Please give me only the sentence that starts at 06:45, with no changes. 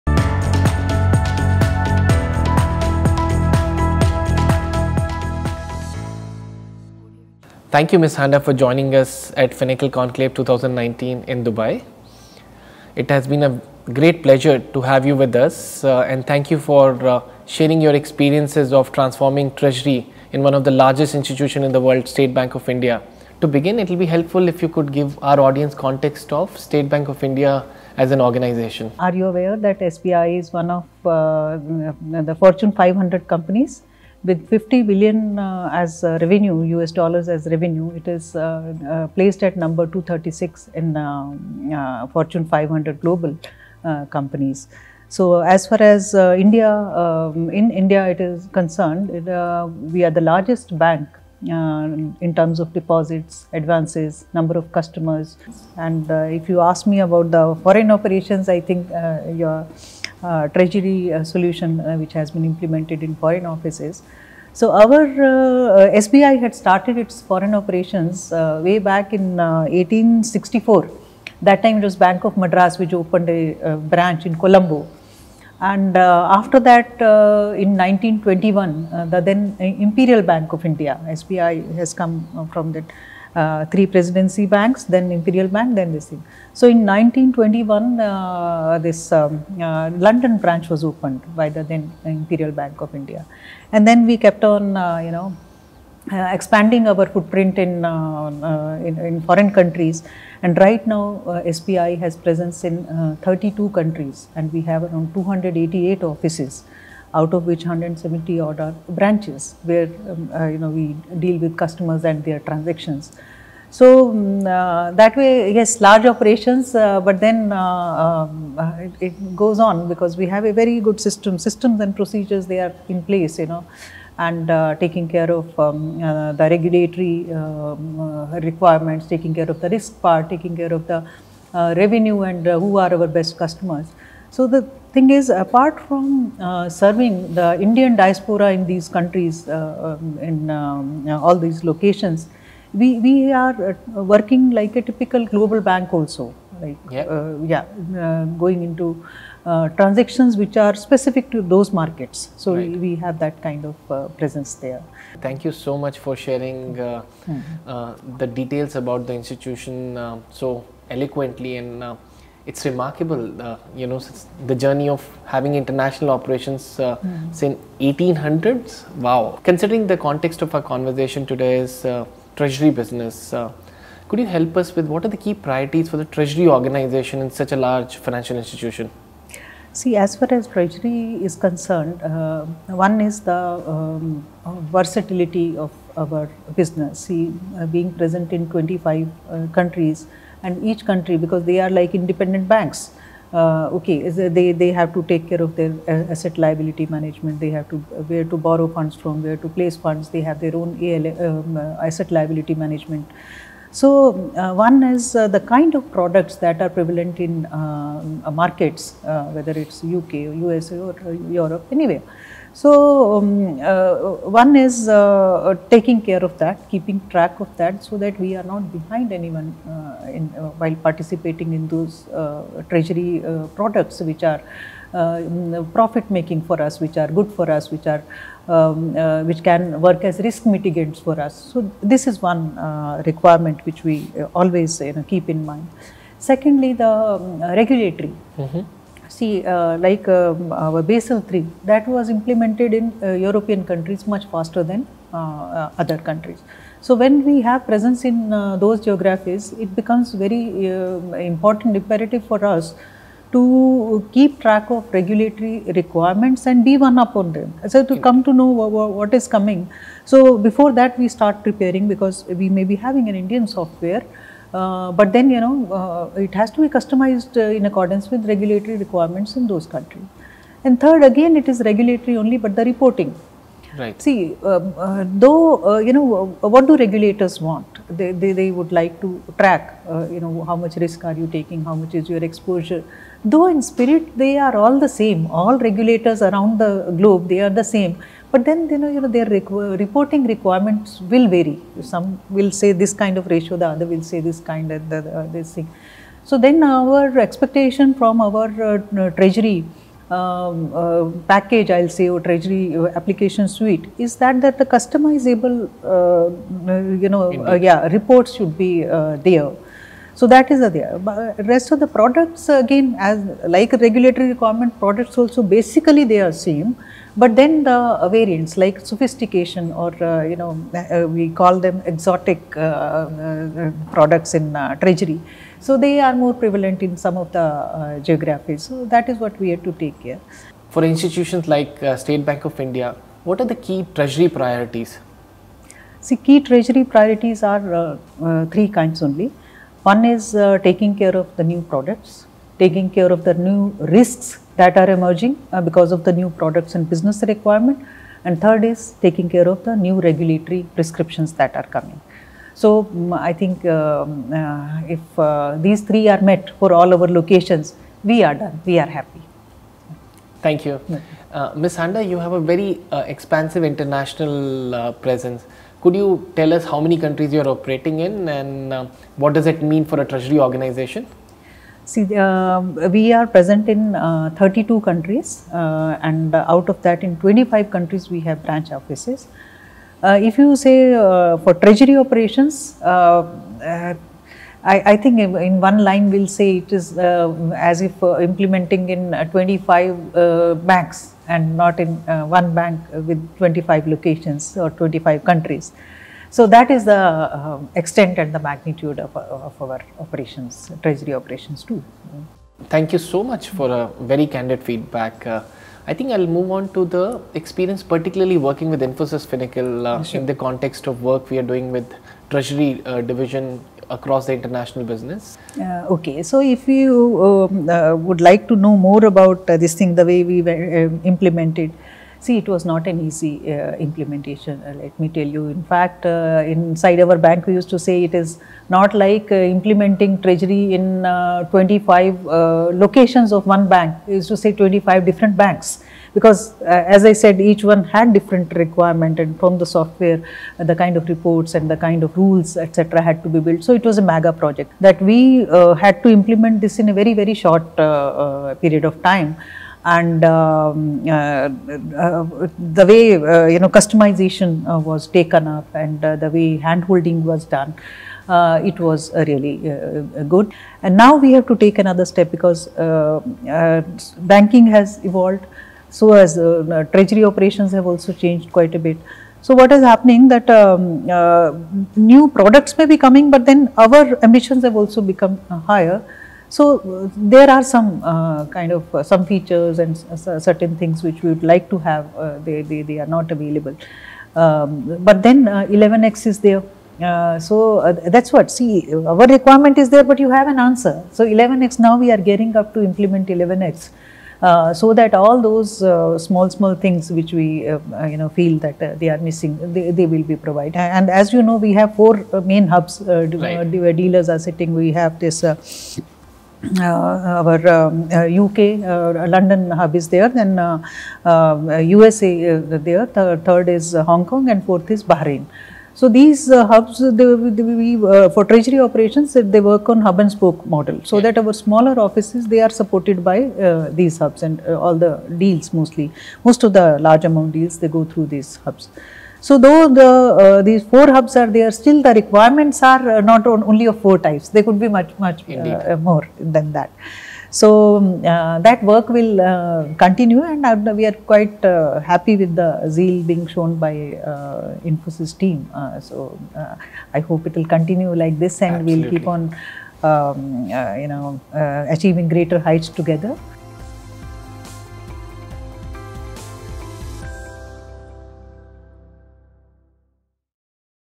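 Uh, I think I'll move on to the experience, particularly working with Infosys Finacle uh, sure.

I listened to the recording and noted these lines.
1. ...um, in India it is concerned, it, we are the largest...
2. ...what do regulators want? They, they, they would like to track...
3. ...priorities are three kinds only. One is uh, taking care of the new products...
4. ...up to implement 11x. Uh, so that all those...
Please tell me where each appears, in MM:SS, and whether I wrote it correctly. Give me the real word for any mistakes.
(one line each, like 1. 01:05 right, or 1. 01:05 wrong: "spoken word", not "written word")
1. 00:46 right
2. 04:36 right
3. 05:36 right
4. 08:12 right.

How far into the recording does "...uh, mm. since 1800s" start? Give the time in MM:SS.
02:46.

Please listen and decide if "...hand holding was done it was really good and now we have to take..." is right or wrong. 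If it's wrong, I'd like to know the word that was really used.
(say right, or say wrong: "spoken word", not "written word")
right.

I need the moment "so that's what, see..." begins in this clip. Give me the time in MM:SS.
08:07.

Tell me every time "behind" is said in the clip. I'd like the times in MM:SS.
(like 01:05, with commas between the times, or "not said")
03:38.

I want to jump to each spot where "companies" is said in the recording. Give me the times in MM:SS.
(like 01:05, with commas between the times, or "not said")
00:33, 00:44.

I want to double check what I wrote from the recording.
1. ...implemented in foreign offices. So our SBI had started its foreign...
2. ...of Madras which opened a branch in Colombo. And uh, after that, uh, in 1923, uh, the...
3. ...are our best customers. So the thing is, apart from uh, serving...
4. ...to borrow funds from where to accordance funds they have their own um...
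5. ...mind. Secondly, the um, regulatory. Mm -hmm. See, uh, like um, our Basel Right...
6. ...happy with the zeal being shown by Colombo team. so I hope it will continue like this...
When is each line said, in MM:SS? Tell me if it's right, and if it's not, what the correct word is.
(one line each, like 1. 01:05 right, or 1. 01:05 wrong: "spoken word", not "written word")
1. 01:02 right
2. 01:12 wrong: "1921", not "1923"
3. 02:12 right
4. 03:18 wrong: "place", not "accordance"
5. 03:55 wrong: "III", not "Right"
6. 09:01 wrong: "Infosys", not "Colombo".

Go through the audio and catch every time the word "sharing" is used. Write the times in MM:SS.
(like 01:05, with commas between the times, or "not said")
00:17, 02:36.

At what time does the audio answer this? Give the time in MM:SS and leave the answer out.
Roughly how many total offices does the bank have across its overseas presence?
01:45.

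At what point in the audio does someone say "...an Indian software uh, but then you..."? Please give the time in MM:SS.
04:23.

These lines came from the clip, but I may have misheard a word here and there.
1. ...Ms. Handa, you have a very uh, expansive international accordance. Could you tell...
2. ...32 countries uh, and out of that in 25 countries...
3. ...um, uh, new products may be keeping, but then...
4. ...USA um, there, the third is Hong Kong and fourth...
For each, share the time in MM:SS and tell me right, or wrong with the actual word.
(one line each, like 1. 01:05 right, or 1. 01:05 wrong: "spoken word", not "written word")
1. 06:01 wrong: "presence", not "accordance"
2. 06:14 right
3. 07:50 wrong: "coming", not "keeping"
4. 08:31 right.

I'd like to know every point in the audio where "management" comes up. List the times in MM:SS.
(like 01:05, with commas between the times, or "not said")
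03:16, 03:22.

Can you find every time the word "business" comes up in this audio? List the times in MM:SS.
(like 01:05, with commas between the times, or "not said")
02:52, 03:06, 05:46, 06:54.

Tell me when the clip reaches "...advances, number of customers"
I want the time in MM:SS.
00:53.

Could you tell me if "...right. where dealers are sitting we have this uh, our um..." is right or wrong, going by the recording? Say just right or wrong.
right.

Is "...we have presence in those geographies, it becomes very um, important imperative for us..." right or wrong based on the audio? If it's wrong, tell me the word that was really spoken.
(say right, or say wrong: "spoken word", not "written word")
right.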